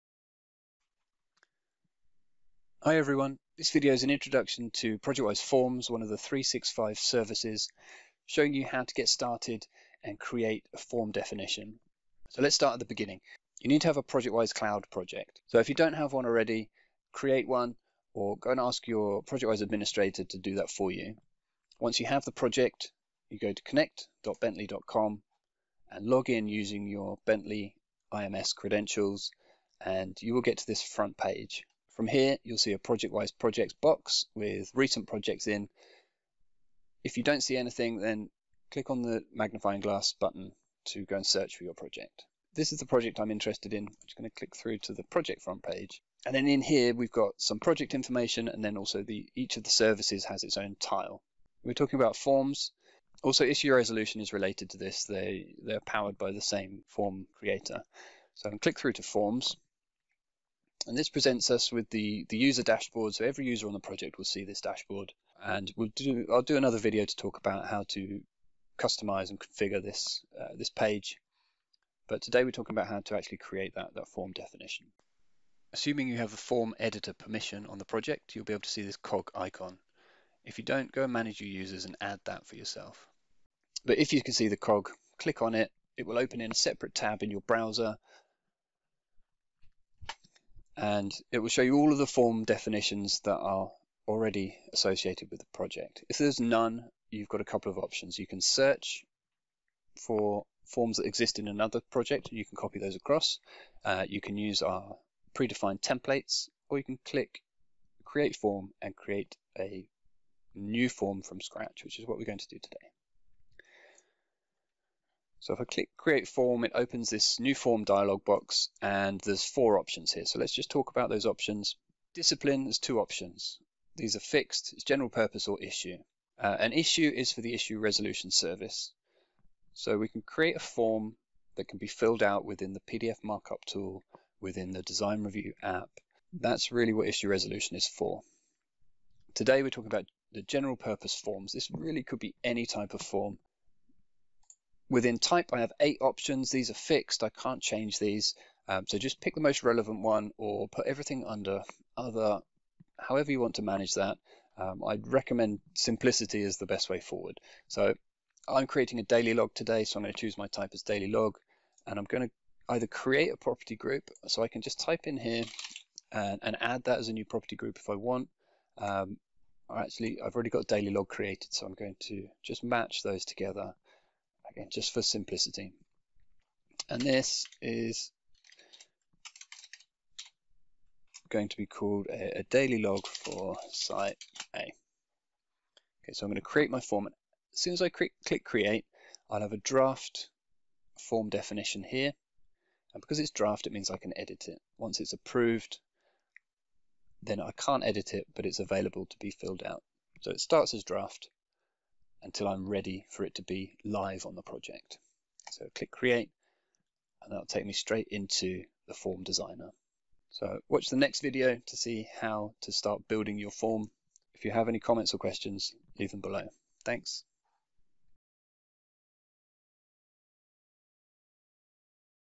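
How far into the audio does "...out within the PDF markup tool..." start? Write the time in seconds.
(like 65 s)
132 s.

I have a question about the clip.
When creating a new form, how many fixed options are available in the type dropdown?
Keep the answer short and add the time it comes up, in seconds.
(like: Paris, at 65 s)
8, at 145 s.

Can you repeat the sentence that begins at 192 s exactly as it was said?
And because it's draft, it means I can edit it.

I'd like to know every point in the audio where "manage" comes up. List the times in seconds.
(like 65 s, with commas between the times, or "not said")
81 s, 153 s.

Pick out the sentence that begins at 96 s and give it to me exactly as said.
If there's none, you've got a couple of options.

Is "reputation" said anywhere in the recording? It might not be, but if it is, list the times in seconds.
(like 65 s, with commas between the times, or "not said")
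not said.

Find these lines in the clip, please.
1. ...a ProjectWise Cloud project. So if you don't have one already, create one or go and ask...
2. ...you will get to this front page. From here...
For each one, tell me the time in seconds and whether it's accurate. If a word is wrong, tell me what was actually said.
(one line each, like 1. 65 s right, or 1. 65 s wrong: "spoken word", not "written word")
1. 13 s right
2. 30 s right.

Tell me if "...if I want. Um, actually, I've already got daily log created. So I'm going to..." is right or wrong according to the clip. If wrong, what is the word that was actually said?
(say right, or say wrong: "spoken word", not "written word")
right.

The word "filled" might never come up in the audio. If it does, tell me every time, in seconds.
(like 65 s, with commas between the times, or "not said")
131 s, 199 s.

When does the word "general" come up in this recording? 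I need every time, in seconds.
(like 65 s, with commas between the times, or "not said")
124 s, 140 s.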